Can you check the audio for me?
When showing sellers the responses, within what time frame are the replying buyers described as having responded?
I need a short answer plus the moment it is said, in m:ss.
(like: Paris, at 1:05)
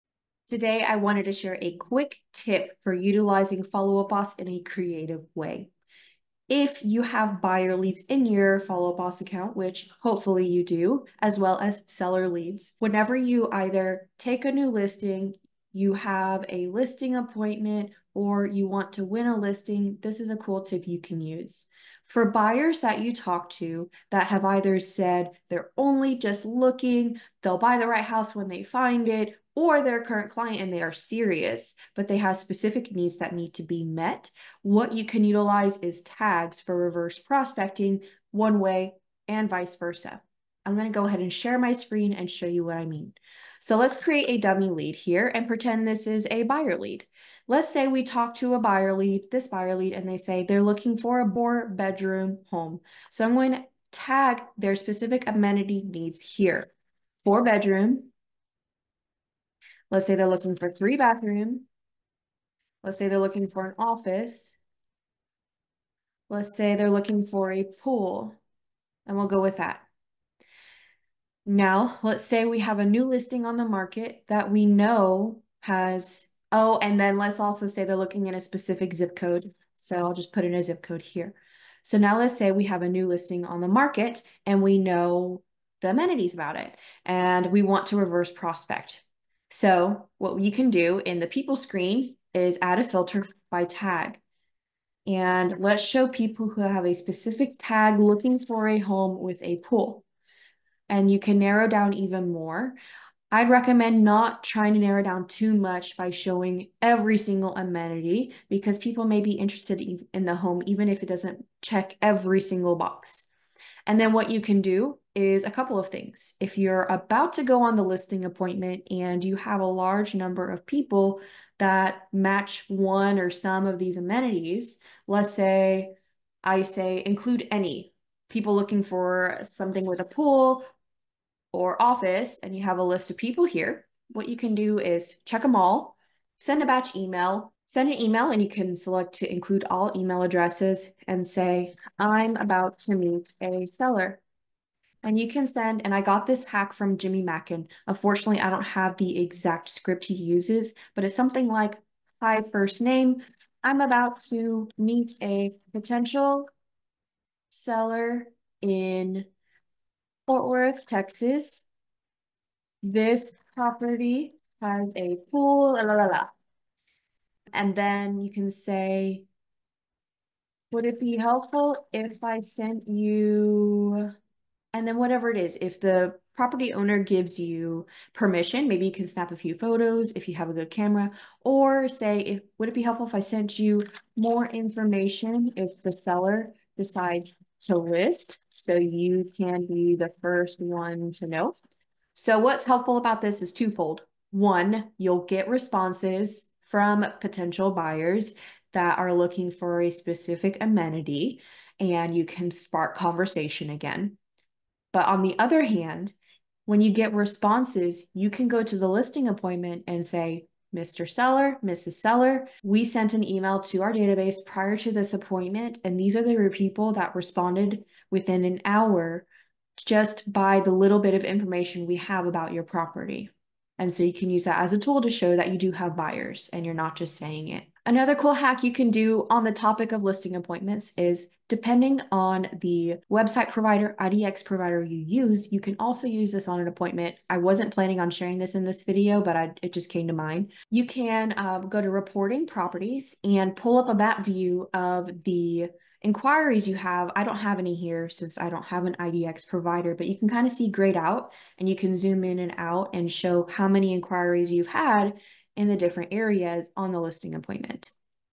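Within an hour, at 3:38.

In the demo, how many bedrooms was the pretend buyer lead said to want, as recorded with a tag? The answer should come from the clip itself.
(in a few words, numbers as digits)
4.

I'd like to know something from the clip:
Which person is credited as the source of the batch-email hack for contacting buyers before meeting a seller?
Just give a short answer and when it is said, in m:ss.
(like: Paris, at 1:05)
Jimmy Mackin, at 2:26.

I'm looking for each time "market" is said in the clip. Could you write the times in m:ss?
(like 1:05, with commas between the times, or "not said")
1:13, 1:23.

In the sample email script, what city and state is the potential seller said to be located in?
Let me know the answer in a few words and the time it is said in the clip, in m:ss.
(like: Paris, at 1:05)
Fort Worth, Texas, at 2:40.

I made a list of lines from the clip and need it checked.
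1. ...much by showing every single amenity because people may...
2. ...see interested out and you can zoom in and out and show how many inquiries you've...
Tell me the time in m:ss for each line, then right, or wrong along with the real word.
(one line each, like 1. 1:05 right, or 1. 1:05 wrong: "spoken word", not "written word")
1. 1:45 right
2. 4:10 wrong: "grayed", not "interested".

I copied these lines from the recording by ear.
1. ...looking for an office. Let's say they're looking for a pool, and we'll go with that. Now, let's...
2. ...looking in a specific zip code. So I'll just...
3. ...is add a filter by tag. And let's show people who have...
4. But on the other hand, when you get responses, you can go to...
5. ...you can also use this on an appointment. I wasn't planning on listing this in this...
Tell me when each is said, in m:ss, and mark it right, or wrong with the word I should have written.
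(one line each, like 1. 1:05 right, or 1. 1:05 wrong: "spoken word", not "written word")
1. 1:03 right
2. 1:17 right
3. 1:32 right
4. 3:24 right
5. 3:55 wrong: "sharing", not "listing".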